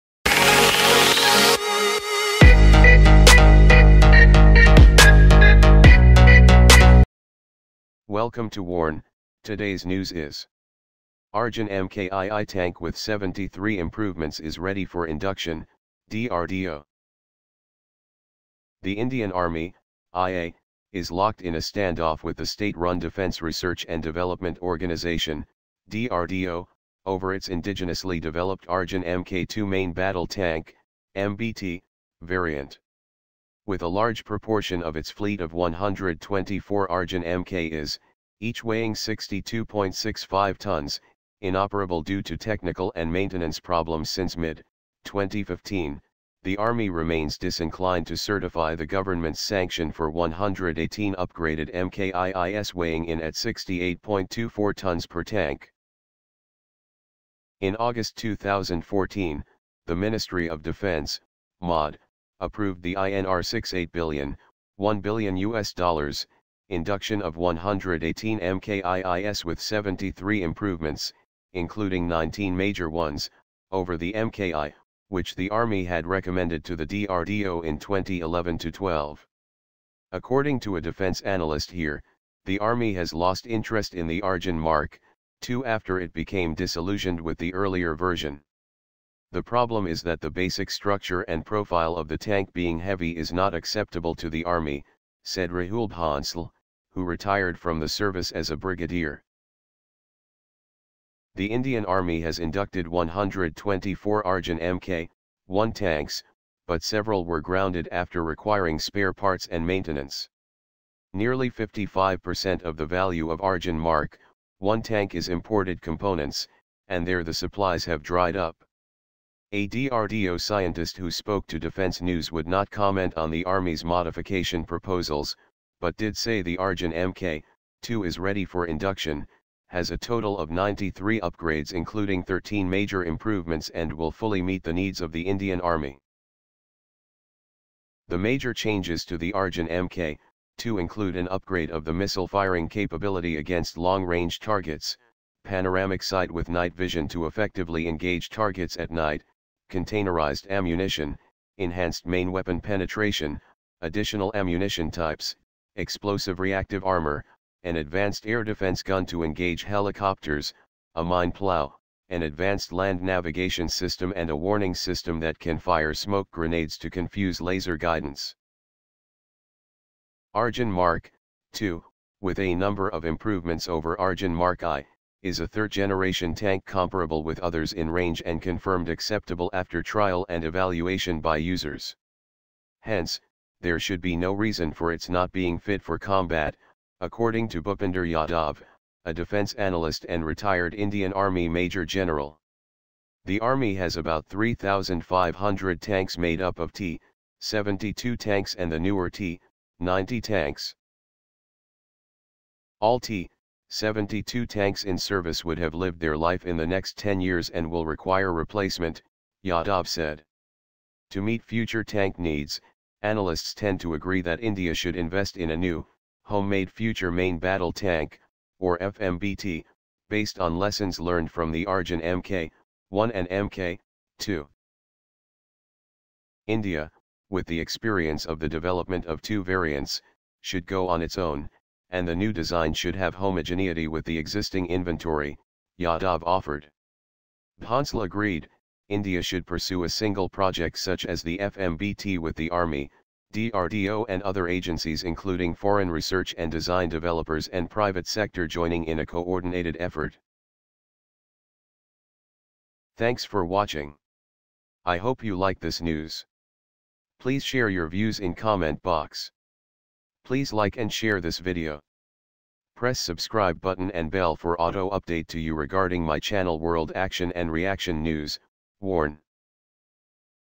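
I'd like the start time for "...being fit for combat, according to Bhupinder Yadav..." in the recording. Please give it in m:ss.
3:05.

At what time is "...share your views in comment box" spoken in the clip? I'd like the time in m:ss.
4:17.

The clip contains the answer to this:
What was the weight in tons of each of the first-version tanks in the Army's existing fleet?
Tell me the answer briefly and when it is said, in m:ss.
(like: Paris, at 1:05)
62.65 tons, at 0:38.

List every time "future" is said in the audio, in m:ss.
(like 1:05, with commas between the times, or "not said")
3:31, 3:36.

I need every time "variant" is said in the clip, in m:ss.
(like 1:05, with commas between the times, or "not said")
0:32, 3:49.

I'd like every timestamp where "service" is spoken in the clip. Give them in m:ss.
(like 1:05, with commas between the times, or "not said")
1:37, 3:24.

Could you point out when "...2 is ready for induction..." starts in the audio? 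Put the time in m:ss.
2:07.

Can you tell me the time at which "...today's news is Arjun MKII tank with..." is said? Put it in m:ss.
0:09.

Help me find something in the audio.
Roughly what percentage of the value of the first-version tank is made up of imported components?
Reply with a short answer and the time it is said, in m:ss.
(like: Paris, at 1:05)
55%, at 1:51.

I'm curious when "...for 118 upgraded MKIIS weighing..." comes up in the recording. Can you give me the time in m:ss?
0:49.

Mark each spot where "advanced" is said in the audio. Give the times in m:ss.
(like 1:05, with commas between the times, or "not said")
2:37, 2:42.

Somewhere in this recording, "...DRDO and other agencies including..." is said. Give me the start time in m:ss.
4:03.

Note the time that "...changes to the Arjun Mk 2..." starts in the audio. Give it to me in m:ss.
2:18.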